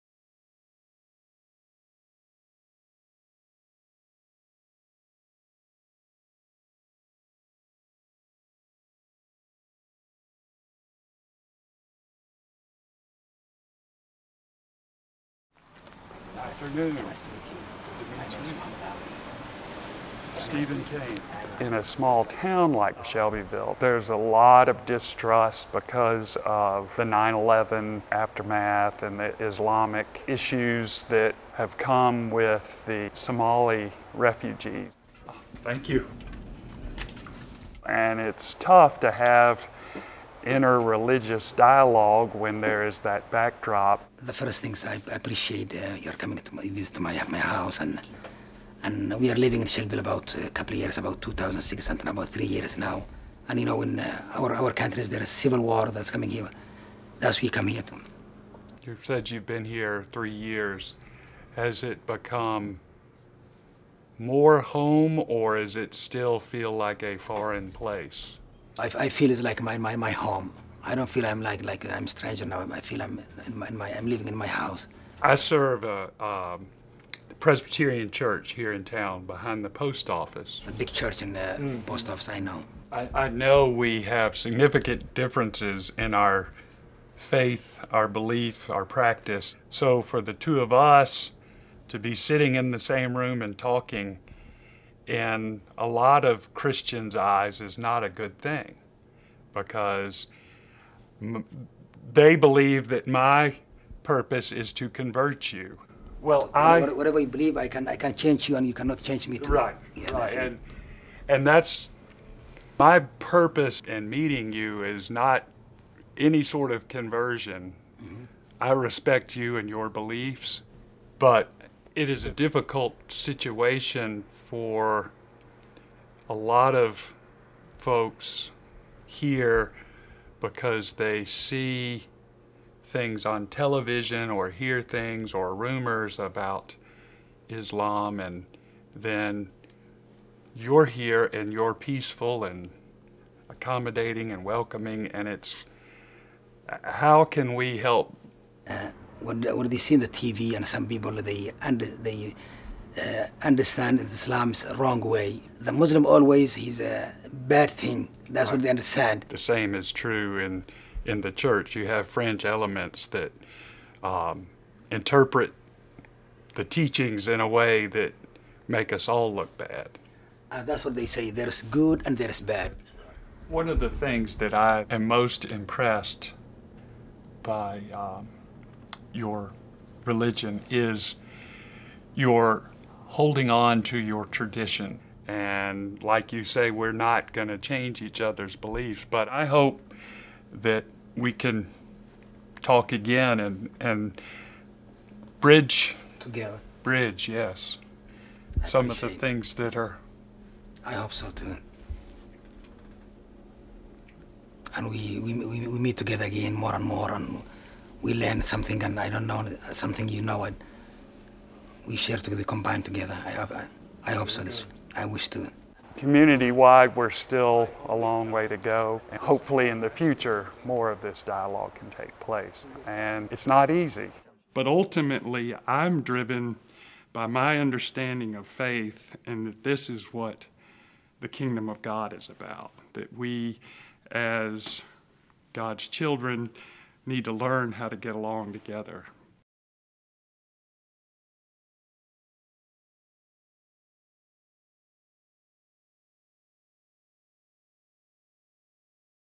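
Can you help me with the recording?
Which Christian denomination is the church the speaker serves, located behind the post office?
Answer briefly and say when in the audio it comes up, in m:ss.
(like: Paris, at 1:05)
Presbyterian, at 1:17.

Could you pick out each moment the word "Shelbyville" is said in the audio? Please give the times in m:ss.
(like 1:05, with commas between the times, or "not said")
0:23, 0:49.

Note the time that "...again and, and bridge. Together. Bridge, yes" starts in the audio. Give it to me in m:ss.
3:12.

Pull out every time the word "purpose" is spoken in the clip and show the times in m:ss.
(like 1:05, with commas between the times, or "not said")
1:44, 1:53.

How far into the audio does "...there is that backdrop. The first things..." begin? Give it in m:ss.
0:42.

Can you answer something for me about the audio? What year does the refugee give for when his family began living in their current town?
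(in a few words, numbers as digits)
2006.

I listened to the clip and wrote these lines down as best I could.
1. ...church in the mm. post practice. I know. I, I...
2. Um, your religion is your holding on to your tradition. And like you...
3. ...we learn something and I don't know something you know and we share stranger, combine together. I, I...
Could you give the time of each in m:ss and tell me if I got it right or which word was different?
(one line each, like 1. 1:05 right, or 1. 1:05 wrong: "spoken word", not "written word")
1. 1:20 wrong: "office", not "practice"
2. 2:57 right
3. 3:28 wrong: "together", not "stranger".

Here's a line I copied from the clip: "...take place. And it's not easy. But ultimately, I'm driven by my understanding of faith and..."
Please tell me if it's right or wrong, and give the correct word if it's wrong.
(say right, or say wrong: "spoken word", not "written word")
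right.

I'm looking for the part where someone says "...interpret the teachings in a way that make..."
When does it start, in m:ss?
2:44.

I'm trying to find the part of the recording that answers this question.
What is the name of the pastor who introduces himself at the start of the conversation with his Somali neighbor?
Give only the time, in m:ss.
0:20.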